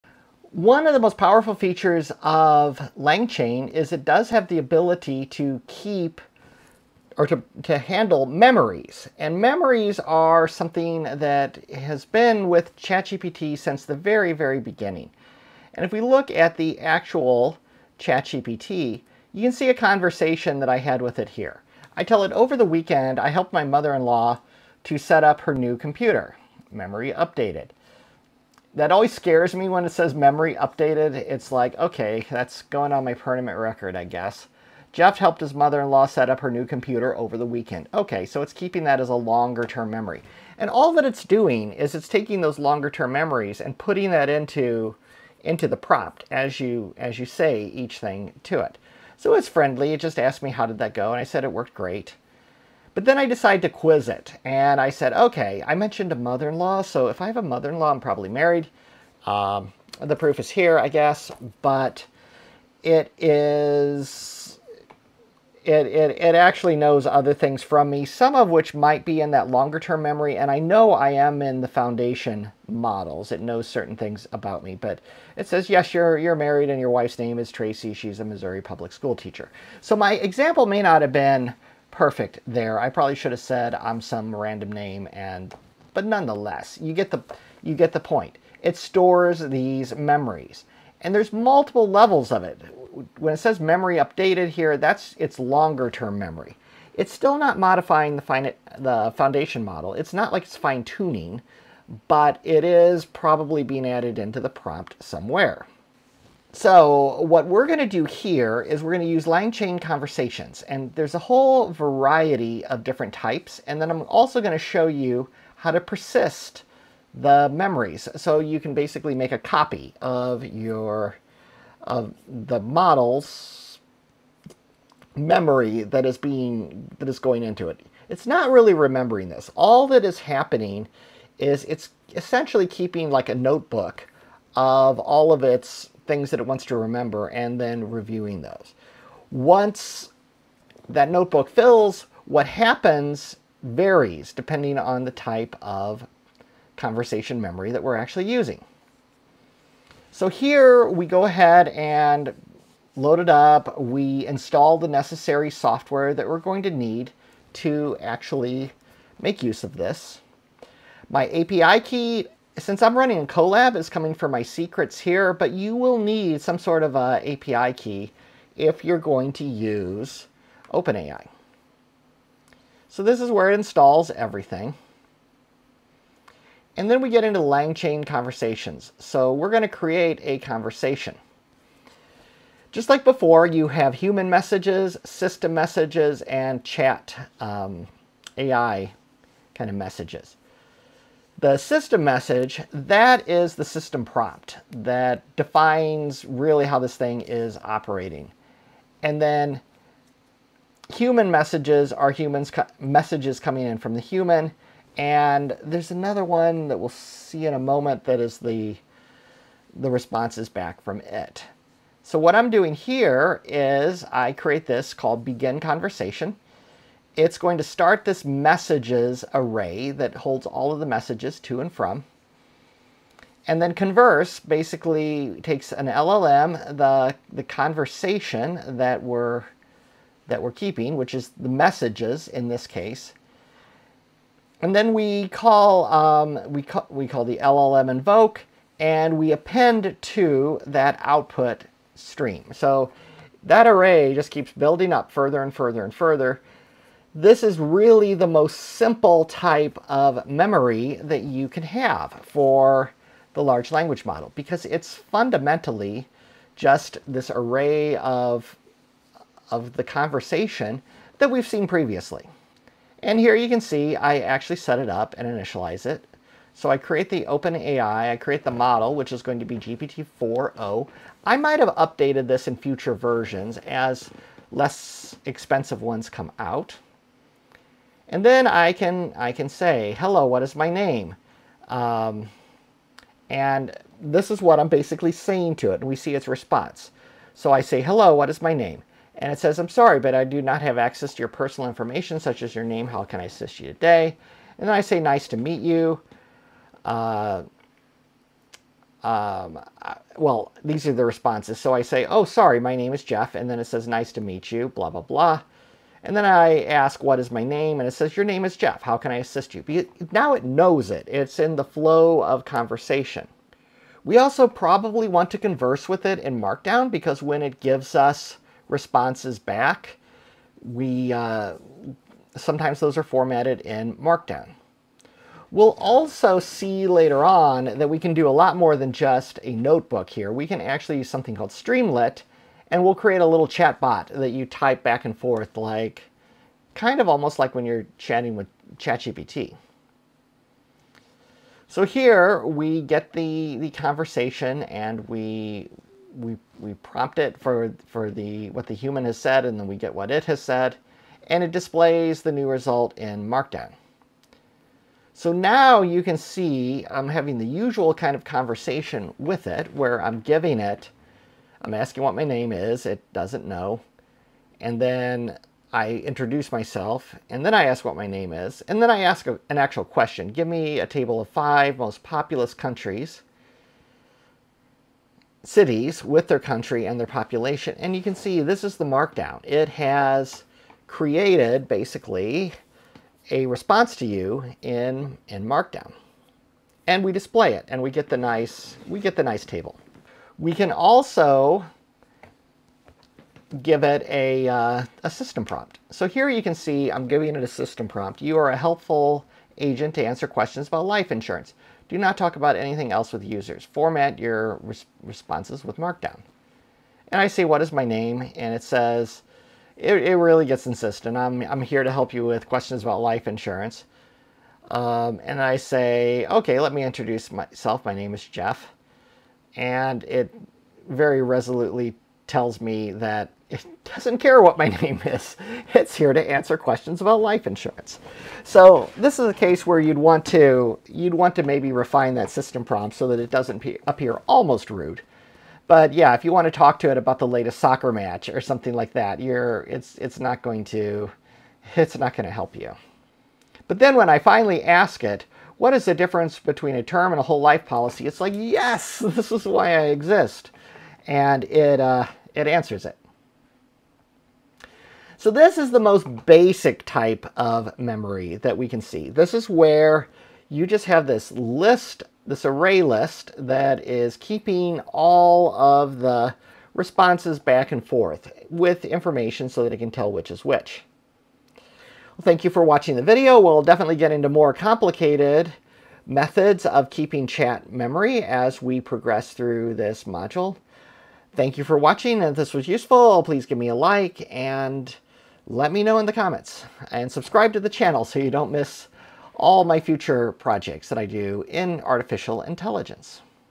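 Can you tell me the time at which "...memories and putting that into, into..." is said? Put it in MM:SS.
00:43.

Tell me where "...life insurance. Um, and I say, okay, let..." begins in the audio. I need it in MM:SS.
06:53.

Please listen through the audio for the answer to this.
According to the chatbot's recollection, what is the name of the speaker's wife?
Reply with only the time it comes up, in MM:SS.
01:17.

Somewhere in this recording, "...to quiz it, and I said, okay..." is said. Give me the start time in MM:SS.
00:53.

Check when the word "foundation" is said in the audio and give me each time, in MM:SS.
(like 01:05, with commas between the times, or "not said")
01:11, 01:39.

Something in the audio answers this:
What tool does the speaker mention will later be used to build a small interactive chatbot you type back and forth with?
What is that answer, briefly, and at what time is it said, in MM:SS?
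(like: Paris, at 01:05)
Streamlit, at 05:31.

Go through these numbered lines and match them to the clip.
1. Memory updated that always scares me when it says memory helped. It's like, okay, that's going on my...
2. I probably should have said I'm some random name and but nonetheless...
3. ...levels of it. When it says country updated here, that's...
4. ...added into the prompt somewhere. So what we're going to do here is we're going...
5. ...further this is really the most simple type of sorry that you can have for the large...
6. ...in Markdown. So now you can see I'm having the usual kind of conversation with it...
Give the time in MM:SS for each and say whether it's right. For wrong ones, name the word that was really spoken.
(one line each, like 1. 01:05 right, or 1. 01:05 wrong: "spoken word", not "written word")
1. 00:26 wrong: "updated", not "helped"
2. 01:22 right
3. 01:31 wrong: "memory", not "country"
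4. 01:43 right
5. 04:05 wrong: "memory", not "sorry"
6. 05:52 right.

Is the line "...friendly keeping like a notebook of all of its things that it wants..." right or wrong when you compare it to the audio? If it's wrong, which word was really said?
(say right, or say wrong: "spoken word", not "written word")
wrong: "essentially", not "friendly".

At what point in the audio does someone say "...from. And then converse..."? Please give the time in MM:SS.
03:41.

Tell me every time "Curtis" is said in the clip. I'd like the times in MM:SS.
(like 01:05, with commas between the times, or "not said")
not said.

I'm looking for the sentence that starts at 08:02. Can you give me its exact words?
If this was useful, please give me a like and let me know in the comments.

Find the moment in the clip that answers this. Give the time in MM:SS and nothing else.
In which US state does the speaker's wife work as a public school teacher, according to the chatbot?
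01:18.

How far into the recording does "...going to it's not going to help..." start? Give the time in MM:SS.
07:20.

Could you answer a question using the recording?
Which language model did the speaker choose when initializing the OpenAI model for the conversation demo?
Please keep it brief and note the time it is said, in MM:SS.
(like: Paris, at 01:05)
GPT-4o, at 04:29.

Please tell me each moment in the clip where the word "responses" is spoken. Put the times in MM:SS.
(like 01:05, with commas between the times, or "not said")
03:29, 04:46, 05:01, 05:18, 06:23, 06:45, 07:46.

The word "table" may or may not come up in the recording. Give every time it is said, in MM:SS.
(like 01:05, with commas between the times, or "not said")
06:10, 06:29.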